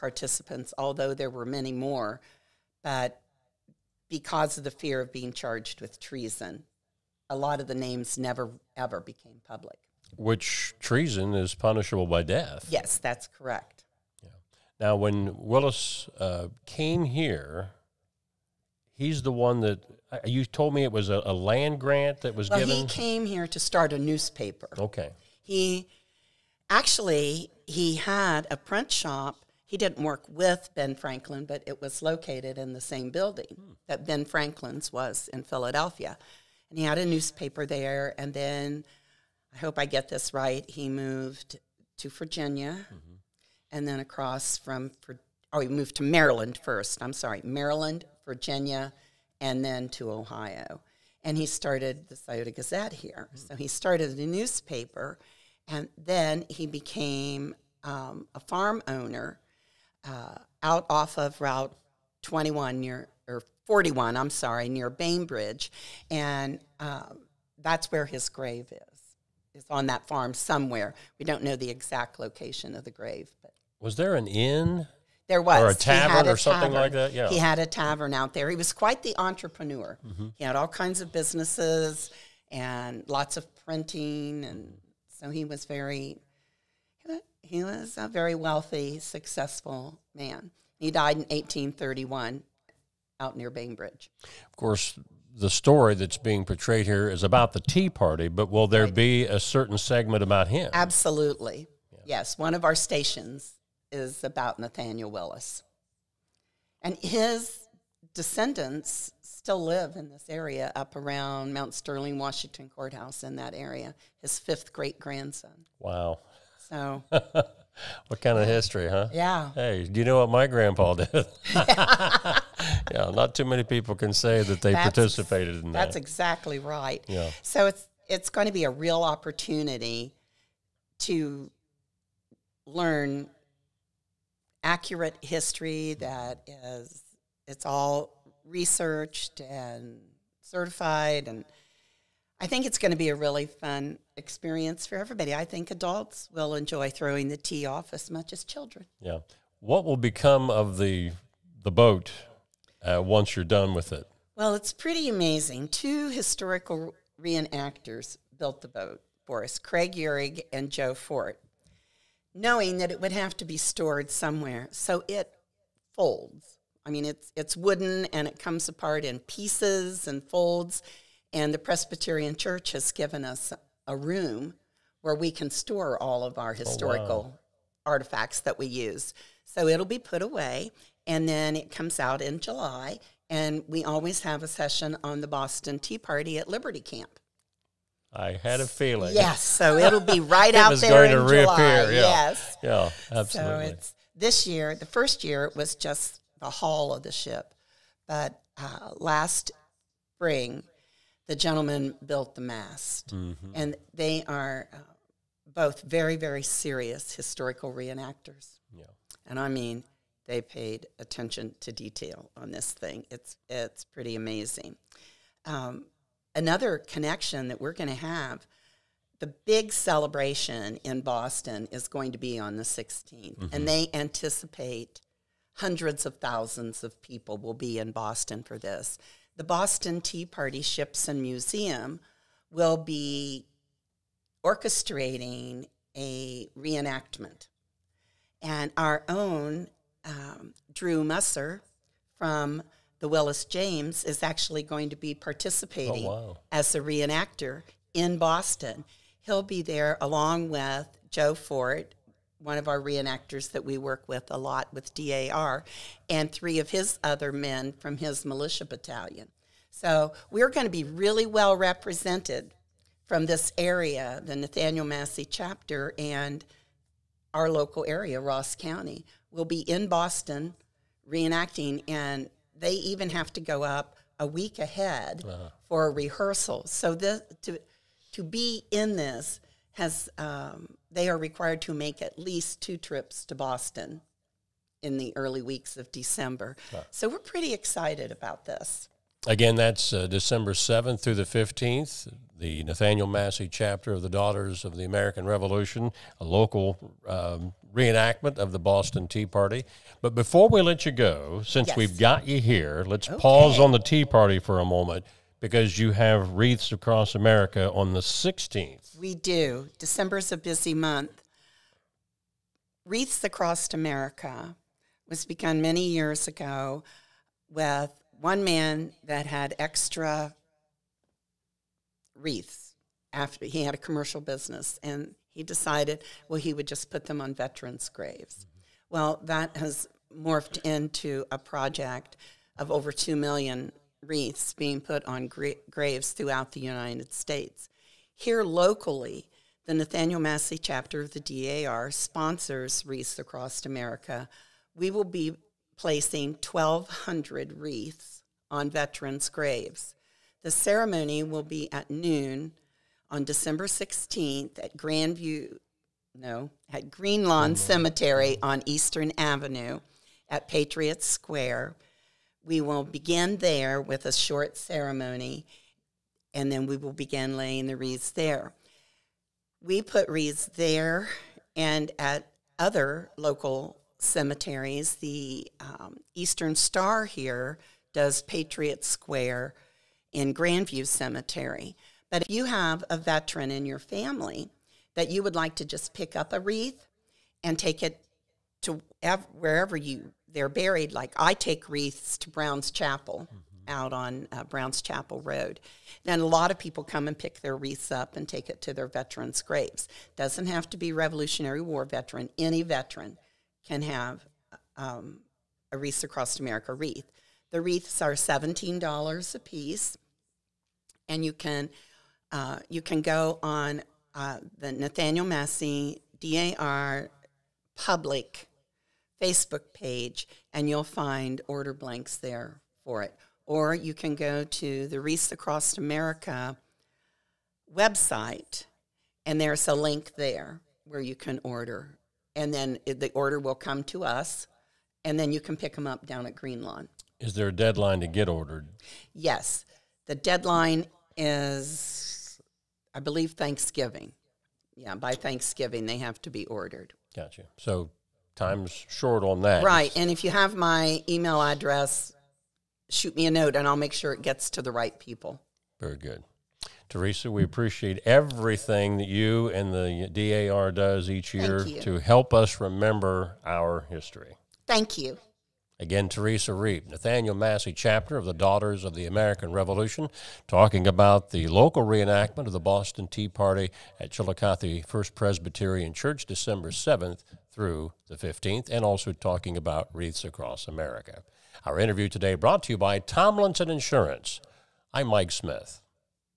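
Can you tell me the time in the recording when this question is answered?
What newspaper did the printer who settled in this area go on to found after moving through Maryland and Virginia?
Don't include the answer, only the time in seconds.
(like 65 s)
52 s.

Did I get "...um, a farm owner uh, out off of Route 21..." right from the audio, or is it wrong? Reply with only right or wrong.
right.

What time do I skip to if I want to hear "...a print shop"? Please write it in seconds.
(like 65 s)
28 s.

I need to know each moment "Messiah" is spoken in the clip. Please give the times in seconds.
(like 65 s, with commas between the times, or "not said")
not said.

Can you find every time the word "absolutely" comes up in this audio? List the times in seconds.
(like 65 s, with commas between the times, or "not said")
100 s, 193 s.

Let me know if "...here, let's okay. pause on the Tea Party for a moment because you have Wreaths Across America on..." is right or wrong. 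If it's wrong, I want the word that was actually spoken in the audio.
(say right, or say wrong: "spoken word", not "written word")
right.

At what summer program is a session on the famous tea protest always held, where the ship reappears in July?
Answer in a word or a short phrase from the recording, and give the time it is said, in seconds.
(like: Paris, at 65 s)
Liberty Camp, at 186 s.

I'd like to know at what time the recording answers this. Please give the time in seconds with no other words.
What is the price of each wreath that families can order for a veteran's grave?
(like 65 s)
408 s.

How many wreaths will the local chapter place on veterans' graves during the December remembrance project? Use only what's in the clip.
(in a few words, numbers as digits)
1,200.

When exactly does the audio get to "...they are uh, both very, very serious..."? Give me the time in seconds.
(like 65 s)
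203 s.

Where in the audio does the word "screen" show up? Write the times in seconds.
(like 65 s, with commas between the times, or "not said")
not said.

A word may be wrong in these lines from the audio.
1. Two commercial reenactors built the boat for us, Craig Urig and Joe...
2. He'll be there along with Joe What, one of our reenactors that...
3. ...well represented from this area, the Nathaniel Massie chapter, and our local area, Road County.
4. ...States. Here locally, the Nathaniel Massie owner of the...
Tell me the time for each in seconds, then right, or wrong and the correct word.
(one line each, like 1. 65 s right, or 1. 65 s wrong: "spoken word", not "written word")
1. 155 s wrong: "historical", not "commercial"
2. 249 s wrong: "Fort", not "What"
3. 261 s wrong: "Ross", not "Road"
4. 337 s wrong: "chapter", not "owner".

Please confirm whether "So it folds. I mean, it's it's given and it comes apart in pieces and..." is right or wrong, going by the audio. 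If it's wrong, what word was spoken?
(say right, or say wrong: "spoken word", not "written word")
wrong: "wooden", not "given".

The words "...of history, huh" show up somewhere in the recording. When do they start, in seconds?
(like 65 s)
118 s.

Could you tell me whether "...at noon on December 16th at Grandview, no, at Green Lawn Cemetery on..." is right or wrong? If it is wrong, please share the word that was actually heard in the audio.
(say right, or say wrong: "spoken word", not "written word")
right.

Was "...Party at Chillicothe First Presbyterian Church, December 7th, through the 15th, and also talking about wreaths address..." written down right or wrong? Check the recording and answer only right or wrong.
wrong.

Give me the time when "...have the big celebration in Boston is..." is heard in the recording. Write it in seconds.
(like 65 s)
217 s.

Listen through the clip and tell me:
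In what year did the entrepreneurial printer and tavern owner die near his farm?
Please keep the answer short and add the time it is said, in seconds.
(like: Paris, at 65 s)
1831, at 91 s.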